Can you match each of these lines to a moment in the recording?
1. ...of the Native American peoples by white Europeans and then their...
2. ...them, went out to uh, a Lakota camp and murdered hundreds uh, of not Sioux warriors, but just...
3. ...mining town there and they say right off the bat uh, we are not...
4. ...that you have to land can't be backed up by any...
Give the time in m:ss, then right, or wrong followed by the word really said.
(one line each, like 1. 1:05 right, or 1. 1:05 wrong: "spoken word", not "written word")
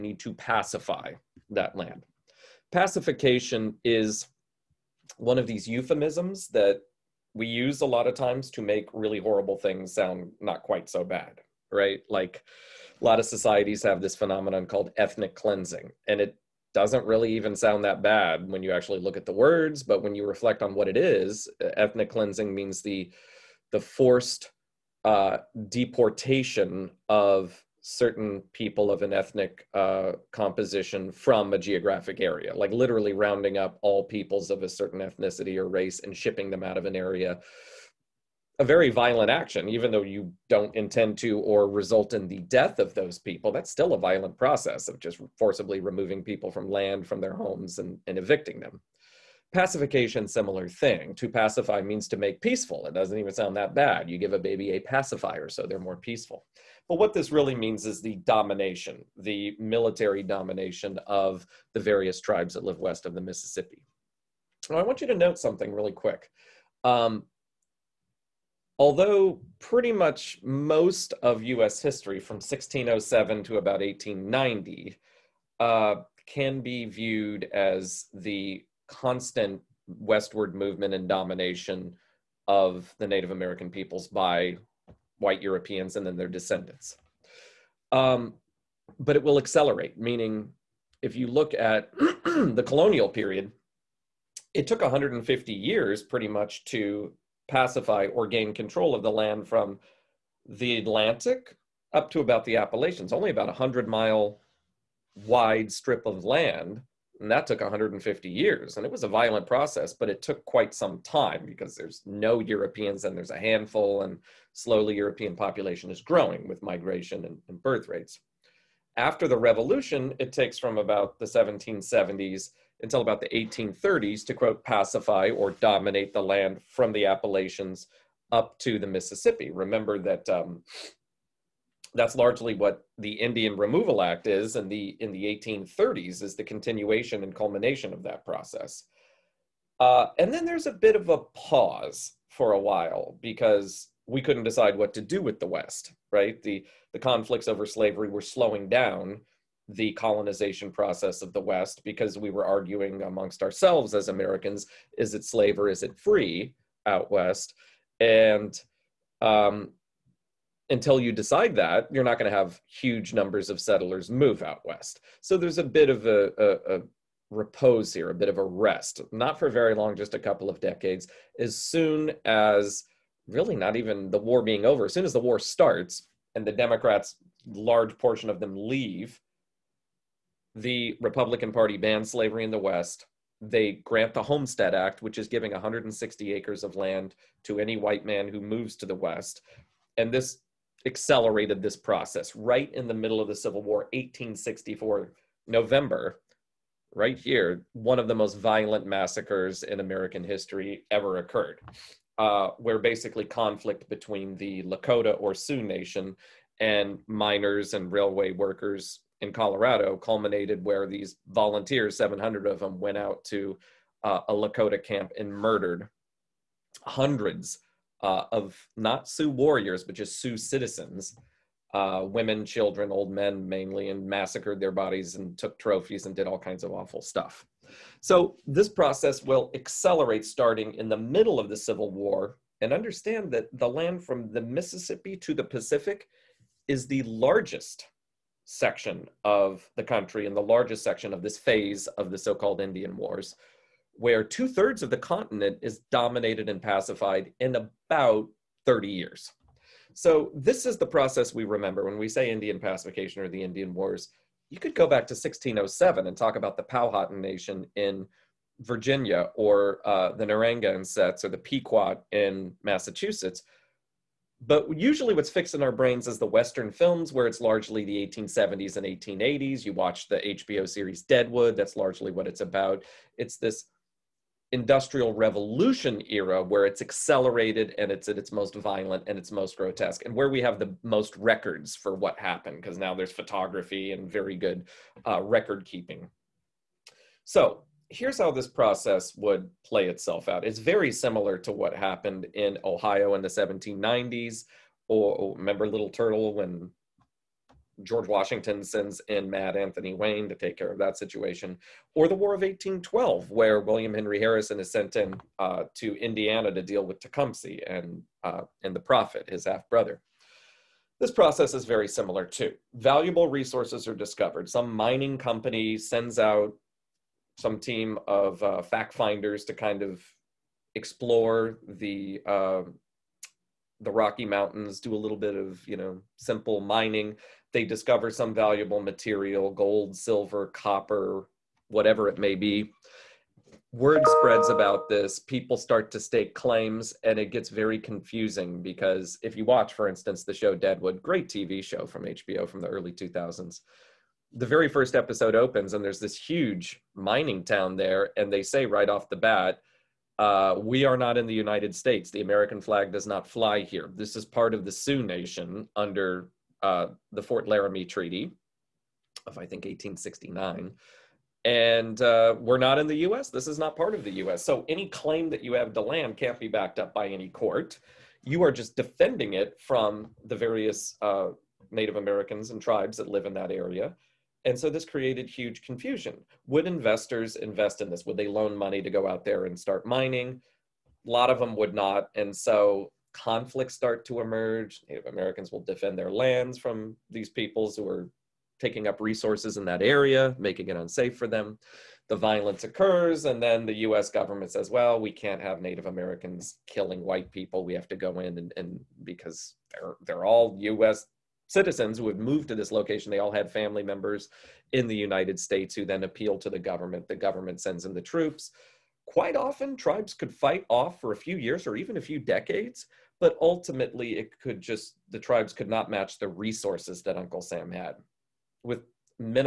1. 1:22 right
2. 3:32 right
3. 5:46 right
4. 6:05 right.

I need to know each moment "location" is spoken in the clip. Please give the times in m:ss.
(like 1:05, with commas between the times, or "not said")
6:42.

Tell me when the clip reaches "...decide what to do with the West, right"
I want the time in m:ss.
2:24.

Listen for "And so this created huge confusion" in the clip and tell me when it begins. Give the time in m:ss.
6:14.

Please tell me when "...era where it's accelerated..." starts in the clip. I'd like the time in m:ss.
4:36.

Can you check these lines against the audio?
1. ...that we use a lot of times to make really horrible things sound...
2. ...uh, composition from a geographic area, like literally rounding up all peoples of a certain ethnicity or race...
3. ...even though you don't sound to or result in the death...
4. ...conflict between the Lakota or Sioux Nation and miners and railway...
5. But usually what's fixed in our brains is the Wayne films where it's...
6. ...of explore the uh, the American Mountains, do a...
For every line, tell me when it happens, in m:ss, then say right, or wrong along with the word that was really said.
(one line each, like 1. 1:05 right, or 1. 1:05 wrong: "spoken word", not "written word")
1. 0:06 right
2. 0:29 right
3. 0:39 wrong: "intend", not "sound"
4. 3:23 right
5. 4:24 wrong: "Western", not "Wayne"
6. 5:19 wrong: "Rocky", not "American".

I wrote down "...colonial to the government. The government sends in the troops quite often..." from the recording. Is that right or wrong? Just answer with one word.
wrong.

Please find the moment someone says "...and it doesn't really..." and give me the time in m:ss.
0:16.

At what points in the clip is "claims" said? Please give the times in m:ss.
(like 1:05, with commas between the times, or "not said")
5:36, 6:04.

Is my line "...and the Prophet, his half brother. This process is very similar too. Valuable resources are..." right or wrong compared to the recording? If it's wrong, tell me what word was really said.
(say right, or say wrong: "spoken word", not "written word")
right.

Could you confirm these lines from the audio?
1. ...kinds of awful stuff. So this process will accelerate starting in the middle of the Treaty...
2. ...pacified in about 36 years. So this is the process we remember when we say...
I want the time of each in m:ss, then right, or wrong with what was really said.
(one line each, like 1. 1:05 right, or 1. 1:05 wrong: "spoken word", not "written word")
1. 3:46 wrong: "Civil", not "Treaty"
2. 4:06 wrong: "30", not "36".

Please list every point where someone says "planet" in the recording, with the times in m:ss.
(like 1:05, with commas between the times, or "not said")
not said.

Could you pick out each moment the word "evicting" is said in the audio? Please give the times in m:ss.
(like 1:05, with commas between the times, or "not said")
0:48.